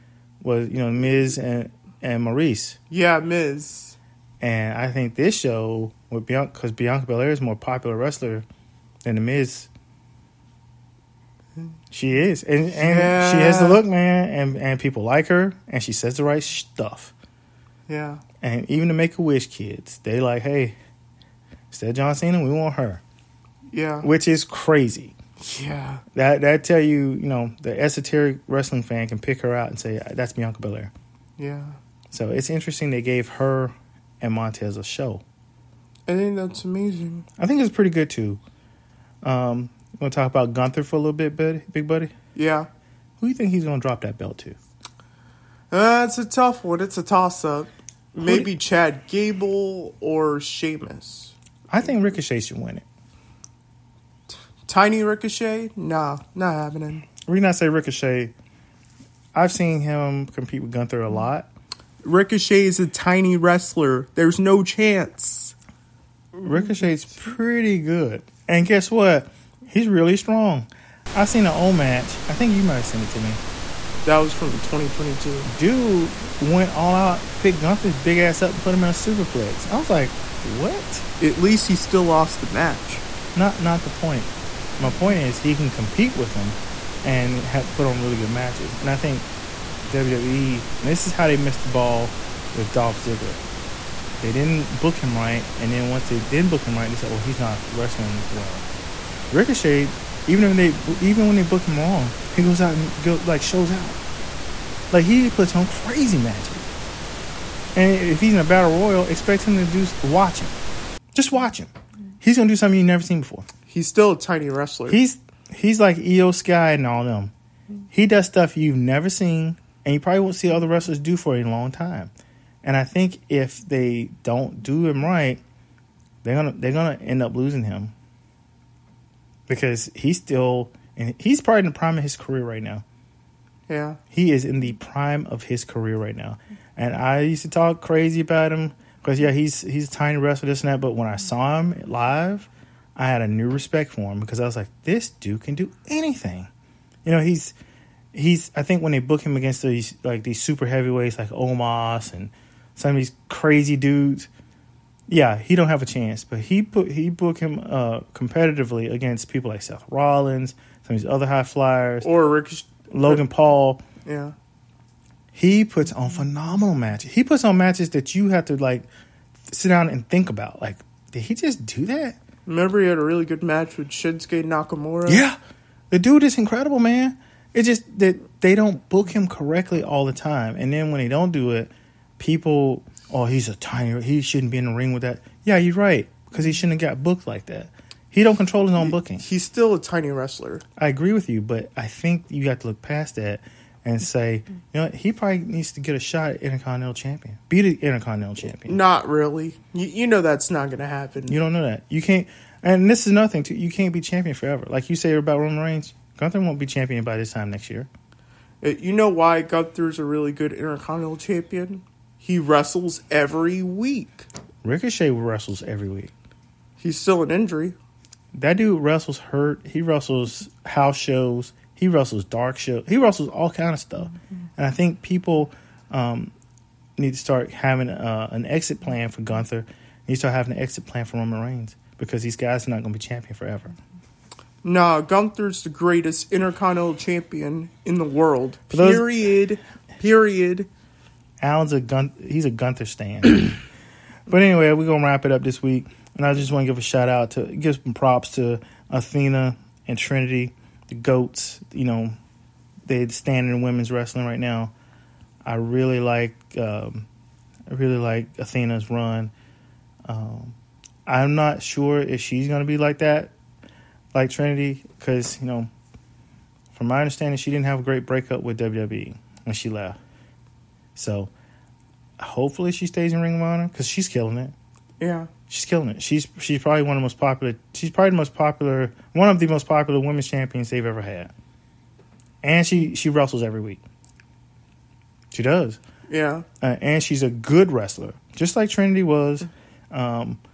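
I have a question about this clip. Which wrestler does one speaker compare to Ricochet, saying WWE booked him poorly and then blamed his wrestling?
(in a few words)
Dolph Ziggler.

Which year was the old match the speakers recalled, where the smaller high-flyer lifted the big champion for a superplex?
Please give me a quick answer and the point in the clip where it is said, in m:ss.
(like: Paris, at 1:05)
2022, at 1:14.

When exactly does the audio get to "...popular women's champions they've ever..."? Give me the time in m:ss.
4:39.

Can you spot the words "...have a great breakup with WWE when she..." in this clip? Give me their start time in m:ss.
4:27.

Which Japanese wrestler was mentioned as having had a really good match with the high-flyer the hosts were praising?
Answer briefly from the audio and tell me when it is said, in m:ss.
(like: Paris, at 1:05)
Shinsuke Nakamura, at 2:53.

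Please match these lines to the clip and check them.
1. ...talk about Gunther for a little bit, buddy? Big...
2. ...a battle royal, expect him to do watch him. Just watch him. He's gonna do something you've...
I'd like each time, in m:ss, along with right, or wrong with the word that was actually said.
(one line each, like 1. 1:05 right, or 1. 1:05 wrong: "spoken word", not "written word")
1. 0:40 right
2. 1:48 right.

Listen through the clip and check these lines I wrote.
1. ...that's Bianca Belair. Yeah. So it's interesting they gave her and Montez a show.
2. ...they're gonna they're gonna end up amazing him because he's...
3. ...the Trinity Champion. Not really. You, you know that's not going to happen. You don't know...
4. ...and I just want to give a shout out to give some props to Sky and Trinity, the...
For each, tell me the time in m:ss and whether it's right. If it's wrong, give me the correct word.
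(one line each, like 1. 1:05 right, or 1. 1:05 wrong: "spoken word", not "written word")
1. 0:30 right
2. 2:06 wrong: "losing", not "amazing"
3. 3:17 wrong: "Intercontinental", not "Trinity"
4. 4:06 wrong: "Athena", not "Sky".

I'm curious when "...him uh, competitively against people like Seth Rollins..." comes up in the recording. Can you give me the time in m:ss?
2:37.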